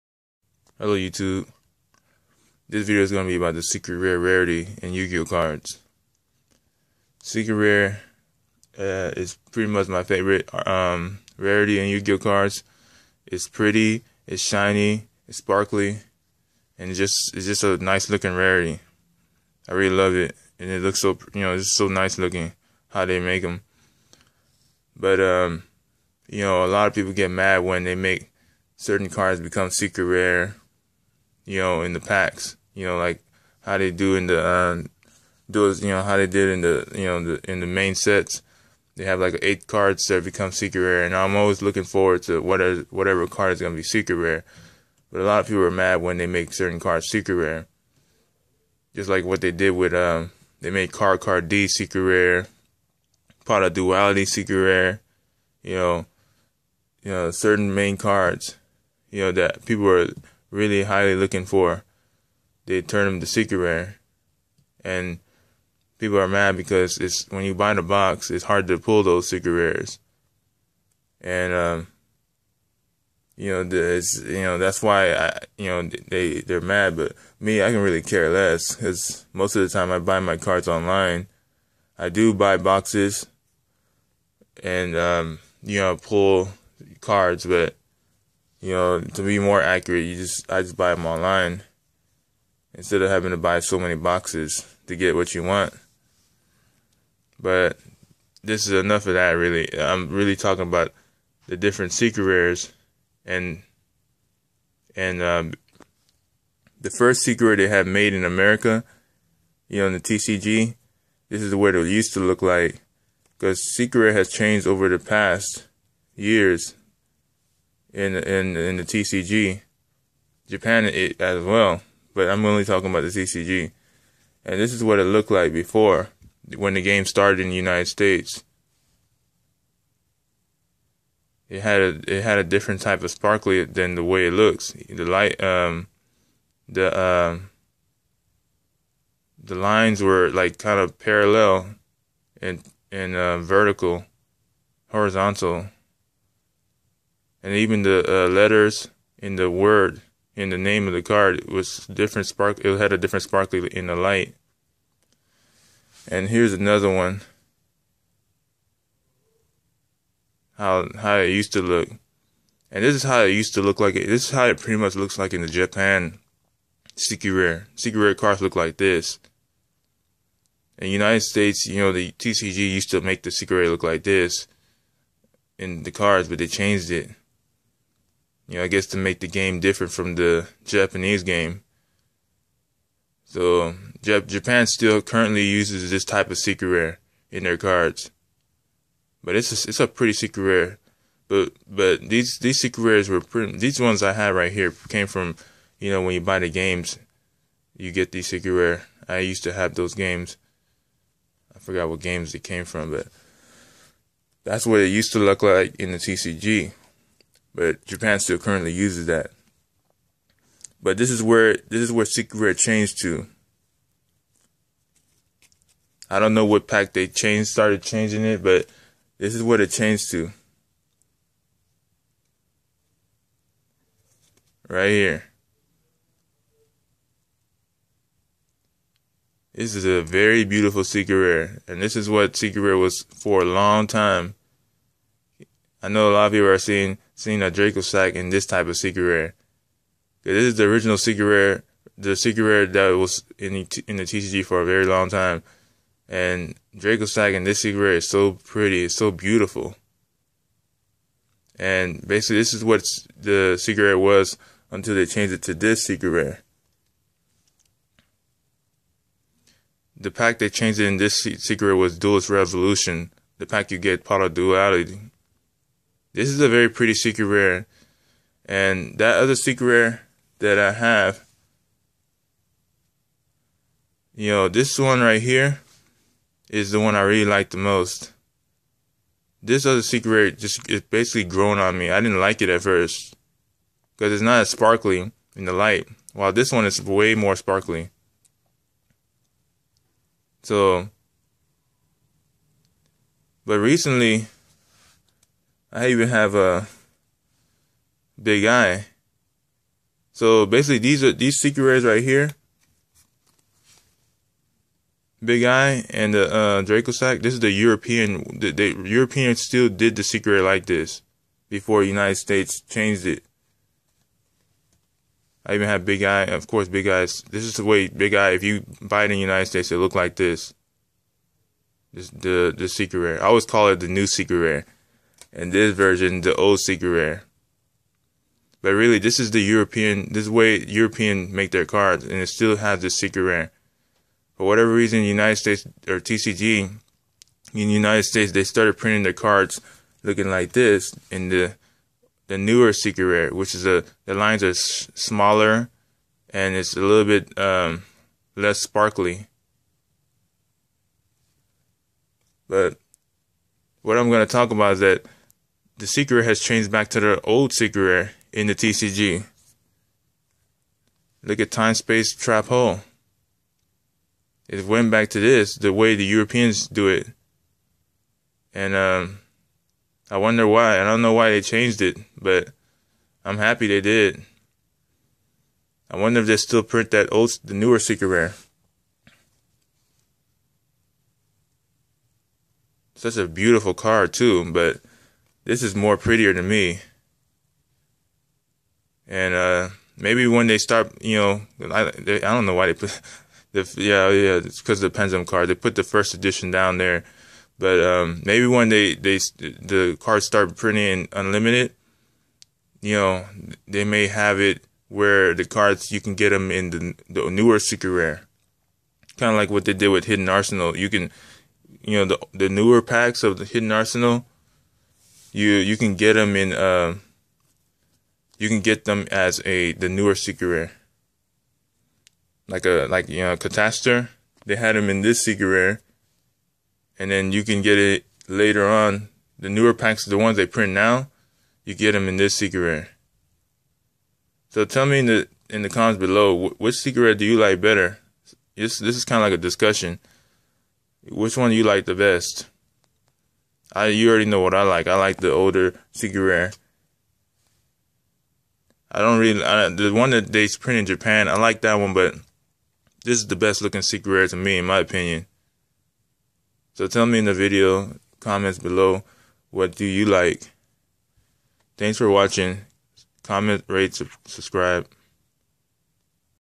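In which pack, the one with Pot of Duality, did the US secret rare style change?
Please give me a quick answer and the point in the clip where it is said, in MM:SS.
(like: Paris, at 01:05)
Duelist Revolution, at 04:21.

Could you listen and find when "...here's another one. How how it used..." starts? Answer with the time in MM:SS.
02:36.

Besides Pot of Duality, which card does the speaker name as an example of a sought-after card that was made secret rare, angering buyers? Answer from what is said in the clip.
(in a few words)
Card Car D.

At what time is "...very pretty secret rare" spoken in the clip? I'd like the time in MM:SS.
04:26.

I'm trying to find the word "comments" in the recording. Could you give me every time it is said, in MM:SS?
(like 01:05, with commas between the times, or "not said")
07:15, 07:38, 07:43.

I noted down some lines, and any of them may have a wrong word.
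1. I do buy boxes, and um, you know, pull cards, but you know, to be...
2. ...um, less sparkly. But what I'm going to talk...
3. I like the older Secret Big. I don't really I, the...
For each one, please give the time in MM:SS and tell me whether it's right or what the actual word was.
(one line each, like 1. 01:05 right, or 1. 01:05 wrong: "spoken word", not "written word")
1. 01:21 right
2. 05:47 right
3. 07:24 wrong: "Rare", not "Big".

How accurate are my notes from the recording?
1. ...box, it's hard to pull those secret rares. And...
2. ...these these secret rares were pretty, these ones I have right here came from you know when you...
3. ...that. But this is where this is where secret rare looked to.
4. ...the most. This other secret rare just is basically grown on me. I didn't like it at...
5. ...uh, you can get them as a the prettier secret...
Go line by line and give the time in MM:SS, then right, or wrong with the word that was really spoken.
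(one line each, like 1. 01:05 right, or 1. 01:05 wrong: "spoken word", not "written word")
1. 01:07 right
2. 03:12 right
3. 03:29 wrong: "changed", not "looked"
4. 04:37 right
5. 06:56 wrong: "newer", not "prettier".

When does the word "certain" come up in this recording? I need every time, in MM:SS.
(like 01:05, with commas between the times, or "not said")
00:28, 00:46, 00:57.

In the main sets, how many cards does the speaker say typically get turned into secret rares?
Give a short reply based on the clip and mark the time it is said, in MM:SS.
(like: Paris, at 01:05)
8, at 00:39.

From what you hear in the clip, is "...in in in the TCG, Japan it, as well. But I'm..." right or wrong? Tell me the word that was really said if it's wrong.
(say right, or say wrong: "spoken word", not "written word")
right.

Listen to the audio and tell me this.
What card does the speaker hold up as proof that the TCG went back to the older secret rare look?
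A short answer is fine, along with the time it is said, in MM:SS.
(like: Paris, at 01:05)
Time Space Trap Hole, at 06:01.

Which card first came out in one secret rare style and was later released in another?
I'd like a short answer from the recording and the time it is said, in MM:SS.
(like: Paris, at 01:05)
Catastor, at 07:03.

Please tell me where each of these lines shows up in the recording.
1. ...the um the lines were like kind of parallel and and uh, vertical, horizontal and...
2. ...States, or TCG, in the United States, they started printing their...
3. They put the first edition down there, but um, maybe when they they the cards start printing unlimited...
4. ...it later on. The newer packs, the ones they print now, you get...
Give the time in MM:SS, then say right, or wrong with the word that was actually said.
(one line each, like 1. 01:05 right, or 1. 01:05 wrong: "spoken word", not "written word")
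1. 02:16 right
2. 05:35 right
3. 06:35 right
4. 07:07 right.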